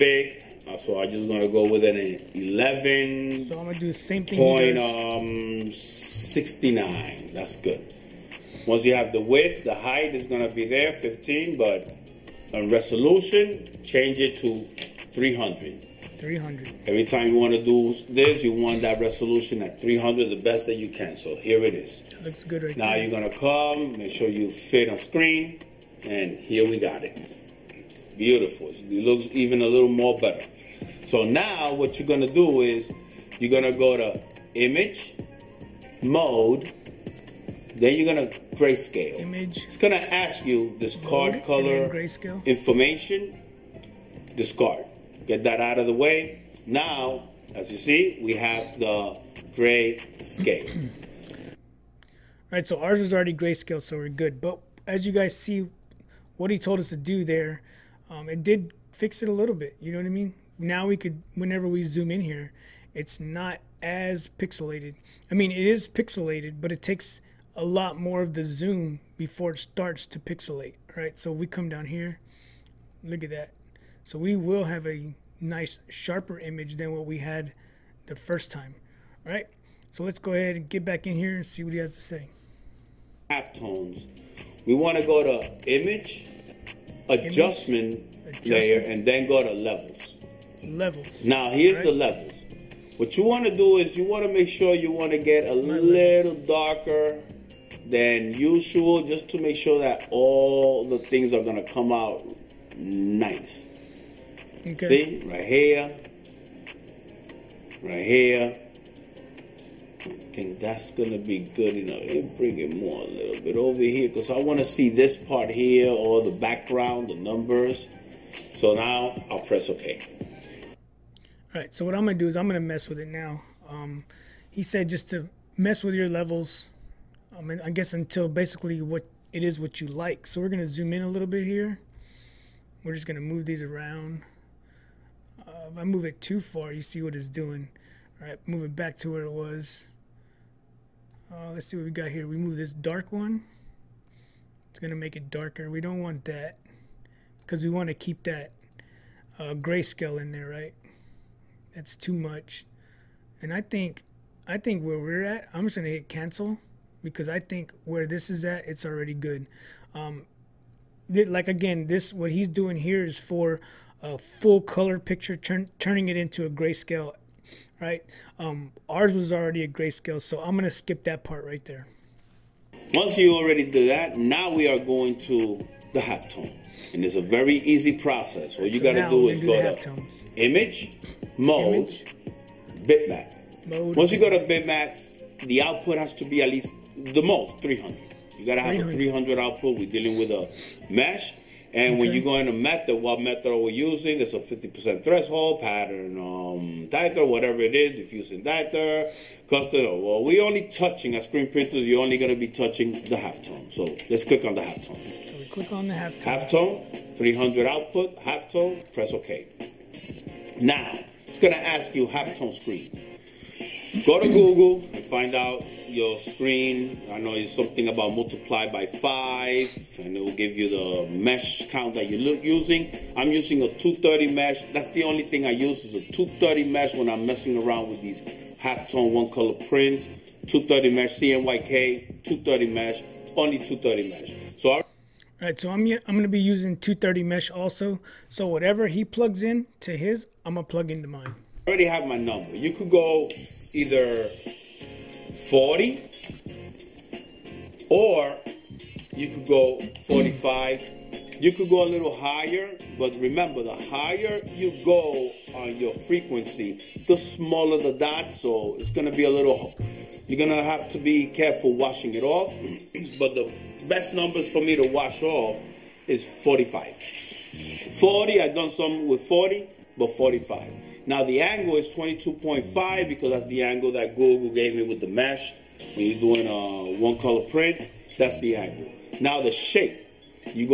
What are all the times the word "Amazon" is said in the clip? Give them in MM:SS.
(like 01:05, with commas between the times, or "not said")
not said.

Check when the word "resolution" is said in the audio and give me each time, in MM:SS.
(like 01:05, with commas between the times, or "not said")
00:12, 00:19.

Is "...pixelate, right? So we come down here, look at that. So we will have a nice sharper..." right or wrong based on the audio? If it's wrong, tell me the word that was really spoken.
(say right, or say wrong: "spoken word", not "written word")
right.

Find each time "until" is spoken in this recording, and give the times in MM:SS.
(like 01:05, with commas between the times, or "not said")
02:07.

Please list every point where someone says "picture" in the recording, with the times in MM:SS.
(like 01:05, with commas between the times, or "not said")
02:44.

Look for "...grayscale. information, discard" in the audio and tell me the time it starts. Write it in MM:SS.
00:41.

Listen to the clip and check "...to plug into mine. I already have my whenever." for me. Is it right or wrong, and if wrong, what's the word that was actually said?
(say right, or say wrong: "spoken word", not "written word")
wrong: "number", not "whenever".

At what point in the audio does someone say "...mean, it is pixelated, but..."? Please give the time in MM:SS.
01:05.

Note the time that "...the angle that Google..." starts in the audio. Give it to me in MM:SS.
04:33.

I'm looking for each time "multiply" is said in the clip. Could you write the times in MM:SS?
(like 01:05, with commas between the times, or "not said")
03:38.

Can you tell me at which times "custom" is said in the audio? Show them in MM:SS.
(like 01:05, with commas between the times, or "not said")
03:19.